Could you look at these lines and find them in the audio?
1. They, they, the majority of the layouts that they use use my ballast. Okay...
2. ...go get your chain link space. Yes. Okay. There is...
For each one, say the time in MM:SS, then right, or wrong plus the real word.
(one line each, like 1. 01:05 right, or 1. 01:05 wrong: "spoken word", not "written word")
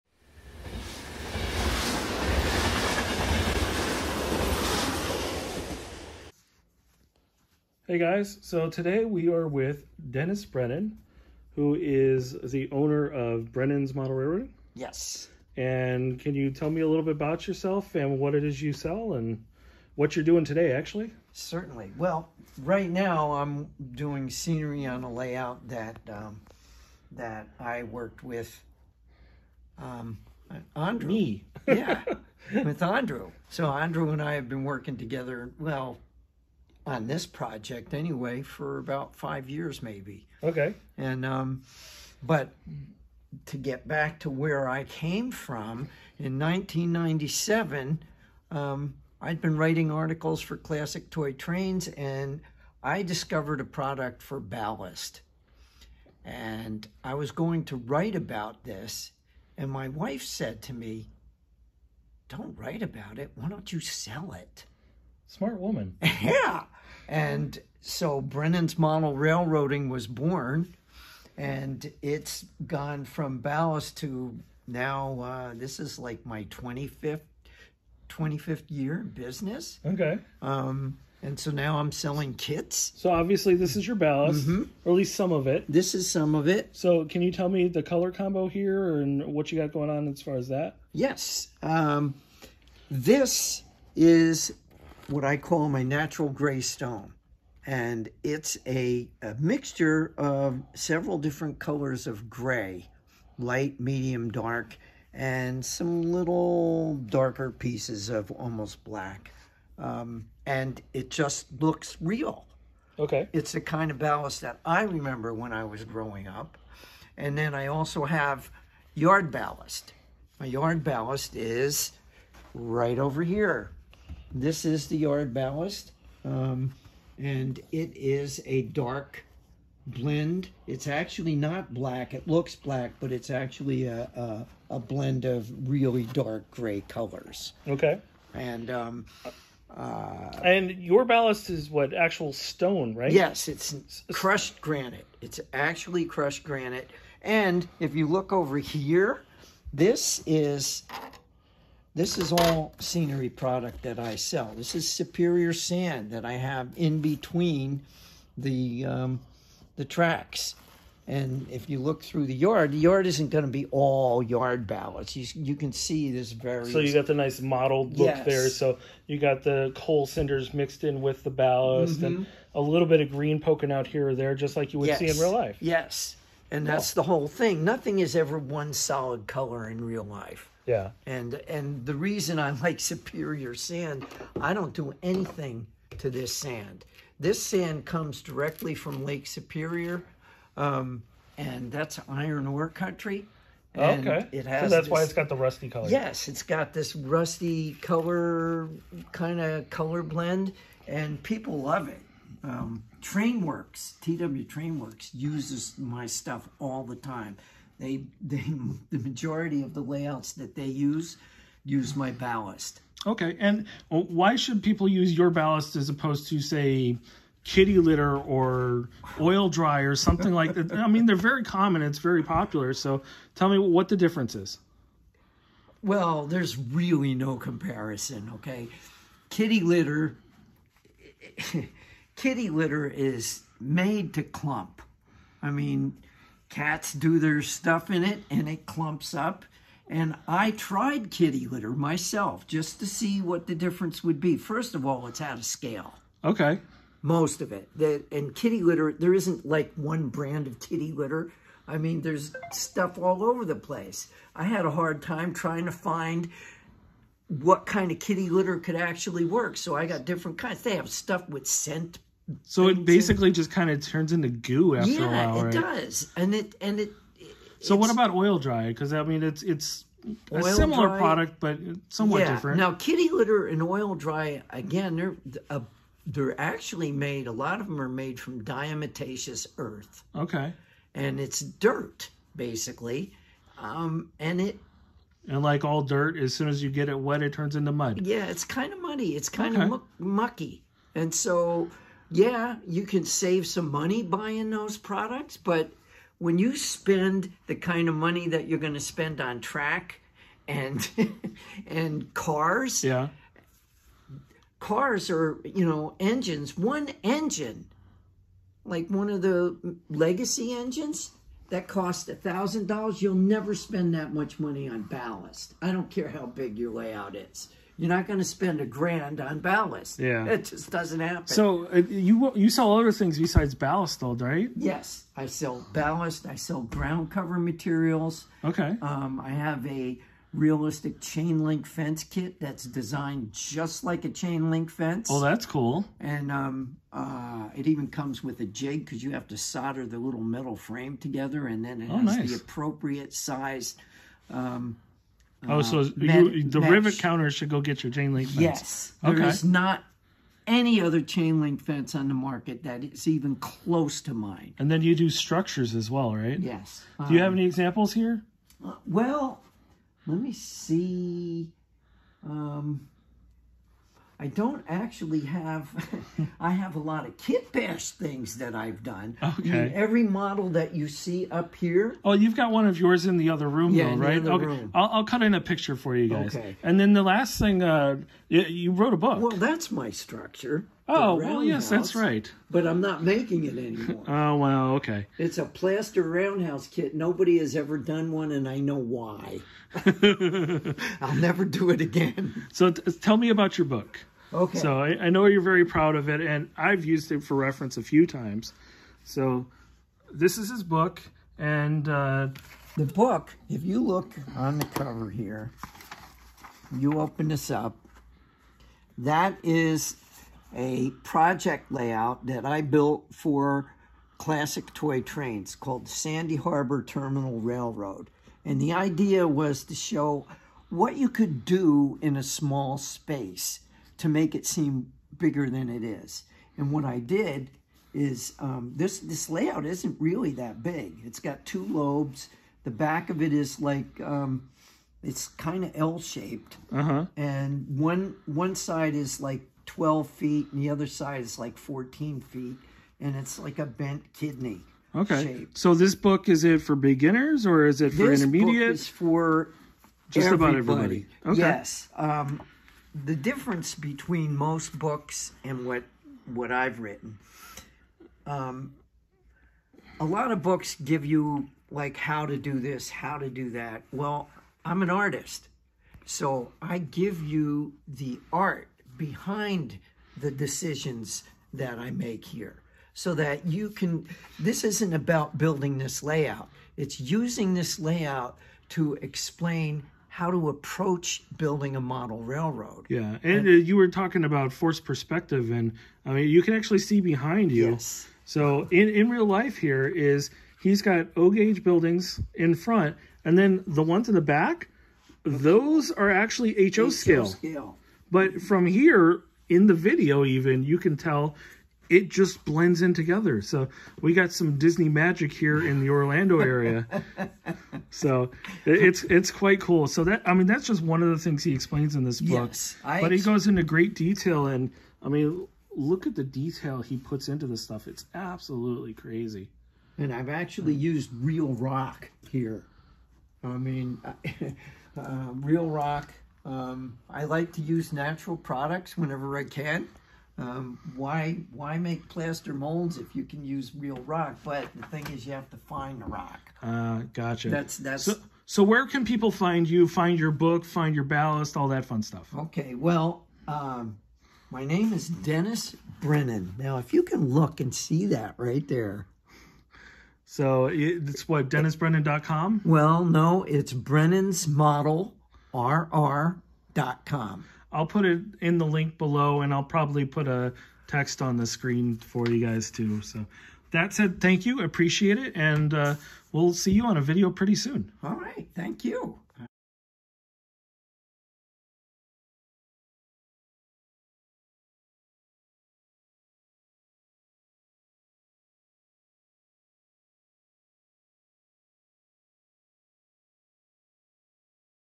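1. 03:27 right
2. 05:47 wrong: "fence", not "space".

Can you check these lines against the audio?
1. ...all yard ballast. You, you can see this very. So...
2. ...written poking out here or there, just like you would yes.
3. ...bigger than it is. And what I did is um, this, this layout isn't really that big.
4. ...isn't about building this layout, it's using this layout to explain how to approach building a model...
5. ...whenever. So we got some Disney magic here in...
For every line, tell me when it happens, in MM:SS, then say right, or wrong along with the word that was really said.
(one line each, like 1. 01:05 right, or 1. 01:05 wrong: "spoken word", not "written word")
1. 02:43 right
2. 02:53 wrong: "green", not "written"
3. 07:05 right
4. 07:54 right
5. 08:22 wrong: "together", not "whenever".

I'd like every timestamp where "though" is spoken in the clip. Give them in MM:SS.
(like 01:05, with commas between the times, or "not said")
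05:24, 06:13.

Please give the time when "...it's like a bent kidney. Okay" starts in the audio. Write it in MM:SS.
07:23.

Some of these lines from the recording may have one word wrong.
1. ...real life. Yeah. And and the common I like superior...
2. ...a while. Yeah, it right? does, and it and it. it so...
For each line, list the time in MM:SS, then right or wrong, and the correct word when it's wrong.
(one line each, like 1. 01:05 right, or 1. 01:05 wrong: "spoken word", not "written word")
1. 02:59 wrong: "reason", not "common"
2. 04:25 right.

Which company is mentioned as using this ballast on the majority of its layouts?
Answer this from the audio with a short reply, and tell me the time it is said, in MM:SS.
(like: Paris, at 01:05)
TW Trainworks, at 03:24.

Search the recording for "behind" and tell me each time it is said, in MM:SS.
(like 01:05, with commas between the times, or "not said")
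07:48, 08:06.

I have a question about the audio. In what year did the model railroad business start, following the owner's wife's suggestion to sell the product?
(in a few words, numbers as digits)
1997.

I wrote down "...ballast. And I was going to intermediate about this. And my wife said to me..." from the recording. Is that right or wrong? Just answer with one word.
wrong.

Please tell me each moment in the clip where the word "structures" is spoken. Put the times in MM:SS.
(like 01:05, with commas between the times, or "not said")
05:55, 06:19.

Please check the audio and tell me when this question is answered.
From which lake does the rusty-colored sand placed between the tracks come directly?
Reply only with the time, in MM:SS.
03:09.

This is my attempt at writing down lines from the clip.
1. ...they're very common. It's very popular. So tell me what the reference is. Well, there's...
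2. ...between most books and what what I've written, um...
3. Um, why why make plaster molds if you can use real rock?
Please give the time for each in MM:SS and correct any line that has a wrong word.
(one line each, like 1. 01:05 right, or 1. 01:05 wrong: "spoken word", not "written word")
1. 03:41 wrong: "difference", not "reference"
2. 07:33 right
3. 08:50 right.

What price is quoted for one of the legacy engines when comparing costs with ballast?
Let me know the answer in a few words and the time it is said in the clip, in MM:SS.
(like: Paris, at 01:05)
$1,000, at 05:12.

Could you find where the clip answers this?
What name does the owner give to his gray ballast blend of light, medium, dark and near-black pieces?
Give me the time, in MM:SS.
01:35.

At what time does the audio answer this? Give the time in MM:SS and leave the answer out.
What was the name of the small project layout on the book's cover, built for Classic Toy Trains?
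06:55.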